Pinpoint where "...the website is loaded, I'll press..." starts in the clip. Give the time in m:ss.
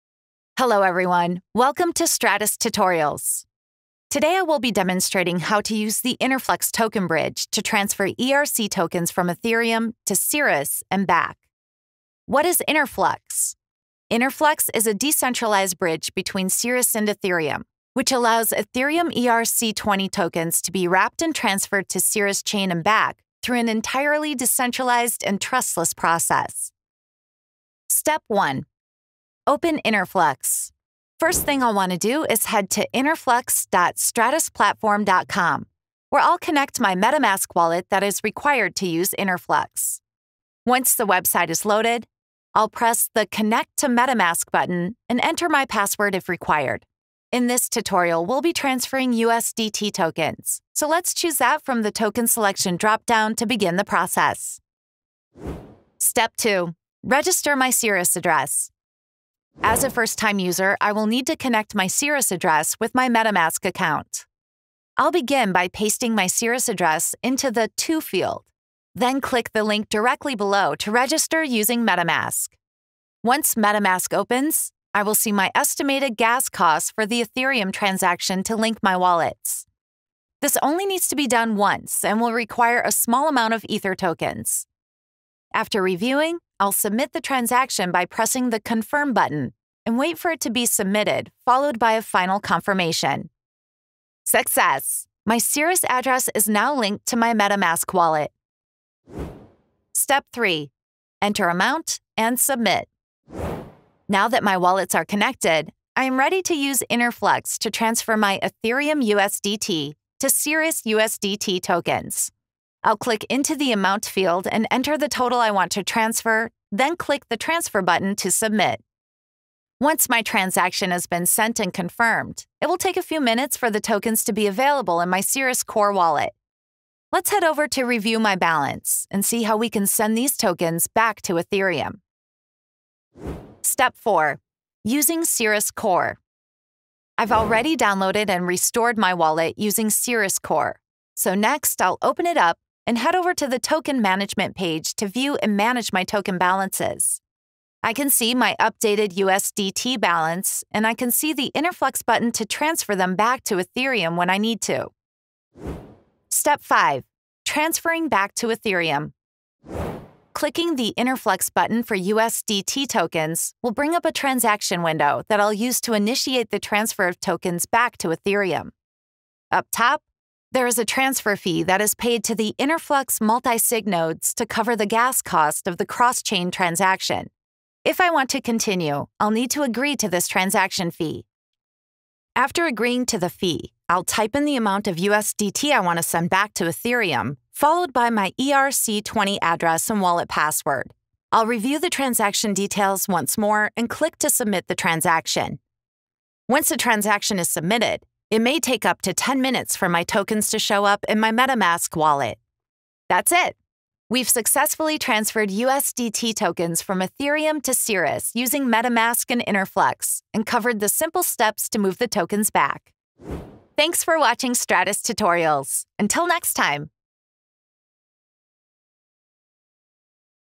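0:40.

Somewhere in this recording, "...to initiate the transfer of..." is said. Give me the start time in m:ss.
2:45.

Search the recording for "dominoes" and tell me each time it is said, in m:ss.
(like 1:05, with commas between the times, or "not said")
not said.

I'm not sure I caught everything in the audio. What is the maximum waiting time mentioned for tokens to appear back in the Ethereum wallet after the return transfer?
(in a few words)
10 minutes.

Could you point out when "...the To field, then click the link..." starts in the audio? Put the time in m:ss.
1:07.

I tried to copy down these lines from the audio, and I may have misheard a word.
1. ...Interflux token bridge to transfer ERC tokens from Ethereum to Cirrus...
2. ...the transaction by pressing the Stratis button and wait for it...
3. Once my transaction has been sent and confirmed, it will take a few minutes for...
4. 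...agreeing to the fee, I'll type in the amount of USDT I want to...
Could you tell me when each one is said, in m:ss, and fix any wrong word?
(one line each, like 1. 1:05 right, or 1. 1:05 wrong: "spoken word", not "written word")
1. 0:06 right
2. 1:27 wrong: "Confirm", not "Stratis"
3. 1:59 right
4. 3:02 right.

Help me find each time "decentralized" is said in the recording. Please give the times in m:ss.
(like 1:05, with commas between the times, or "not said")
0:14, 0:24.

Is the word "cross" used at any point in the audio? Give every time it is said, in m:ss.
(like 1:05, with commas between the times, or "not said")
2:55.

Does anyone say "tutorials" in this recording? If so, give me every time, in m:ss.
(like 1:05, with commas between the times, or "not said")
0:02, 0:47, 3:35.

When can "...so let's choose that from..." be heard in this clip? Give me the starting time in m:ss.
0:50.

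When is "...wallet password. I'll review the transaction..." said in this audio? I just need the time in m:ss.
3:09.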